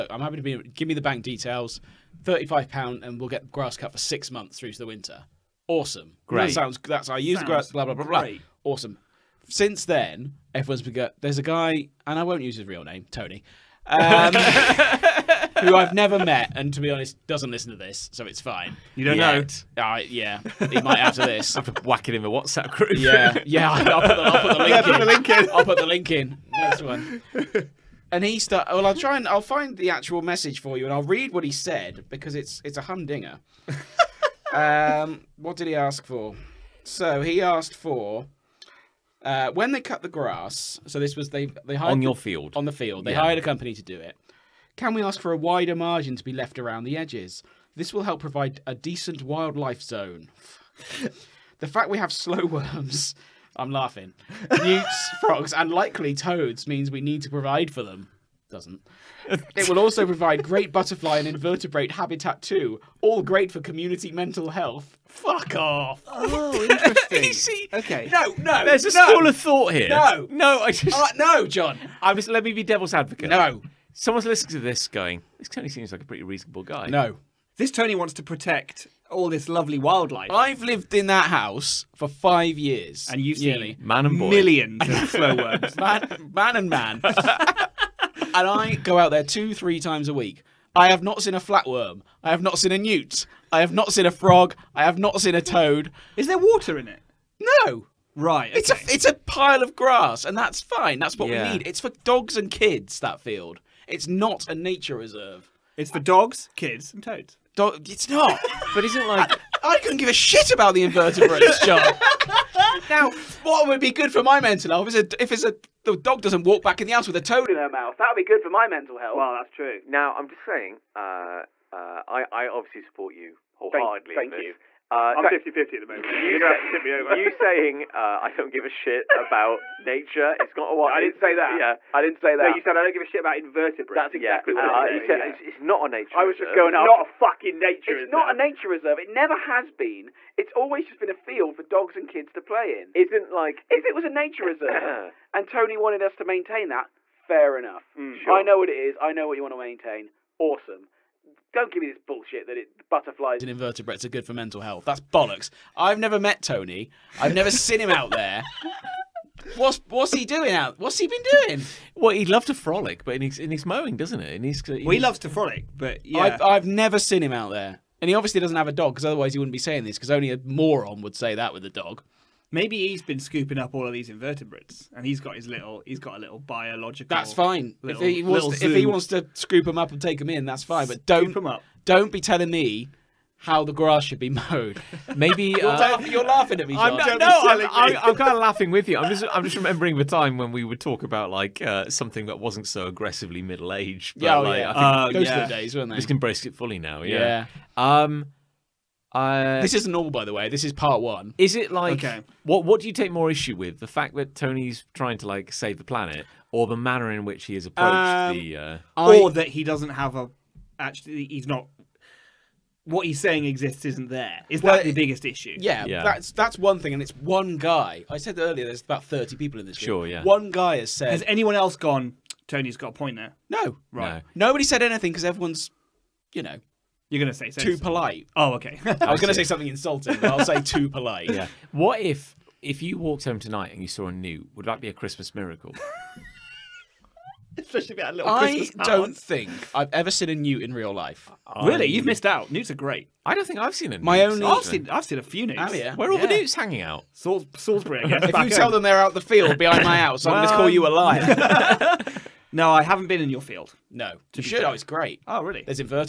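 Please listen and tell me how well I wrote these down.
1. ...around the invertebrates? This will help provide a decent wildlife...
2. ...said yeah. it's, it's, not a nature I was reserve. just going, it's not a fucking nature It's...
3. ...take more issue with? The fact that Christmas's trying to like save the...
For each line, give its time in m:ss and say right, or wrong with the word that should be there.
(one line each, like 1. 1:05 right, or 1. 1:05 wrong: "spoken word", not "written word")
1. 0:46 wrong: "edges", not "invertebrates"
2. 2:15 right
3. 3:22 wrong: "Tony", not "Christmas".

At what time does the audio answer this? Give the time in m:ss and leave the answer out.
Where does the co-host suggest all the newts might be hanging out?
4:07.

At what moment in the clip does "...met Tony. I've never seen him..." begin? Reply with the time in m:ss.
2:36.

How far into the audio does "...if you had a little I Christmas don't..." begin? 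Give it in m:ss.
3:57.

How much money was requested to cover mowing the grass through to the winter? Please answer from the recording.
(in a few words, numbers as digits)
£35.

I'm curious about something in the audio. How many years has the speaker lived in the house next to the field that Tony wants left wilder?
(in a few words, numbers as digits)
5.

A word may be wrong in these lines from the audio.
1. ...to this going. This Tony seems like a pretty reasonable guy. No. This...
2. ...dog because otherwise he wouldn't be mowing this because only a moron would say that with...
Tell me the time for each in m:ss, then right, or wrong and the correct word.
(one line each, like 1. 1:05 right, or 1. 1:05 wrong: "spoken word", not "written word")
1. 1:14 right
2. 2:48 wrong: "saying", not "mowing".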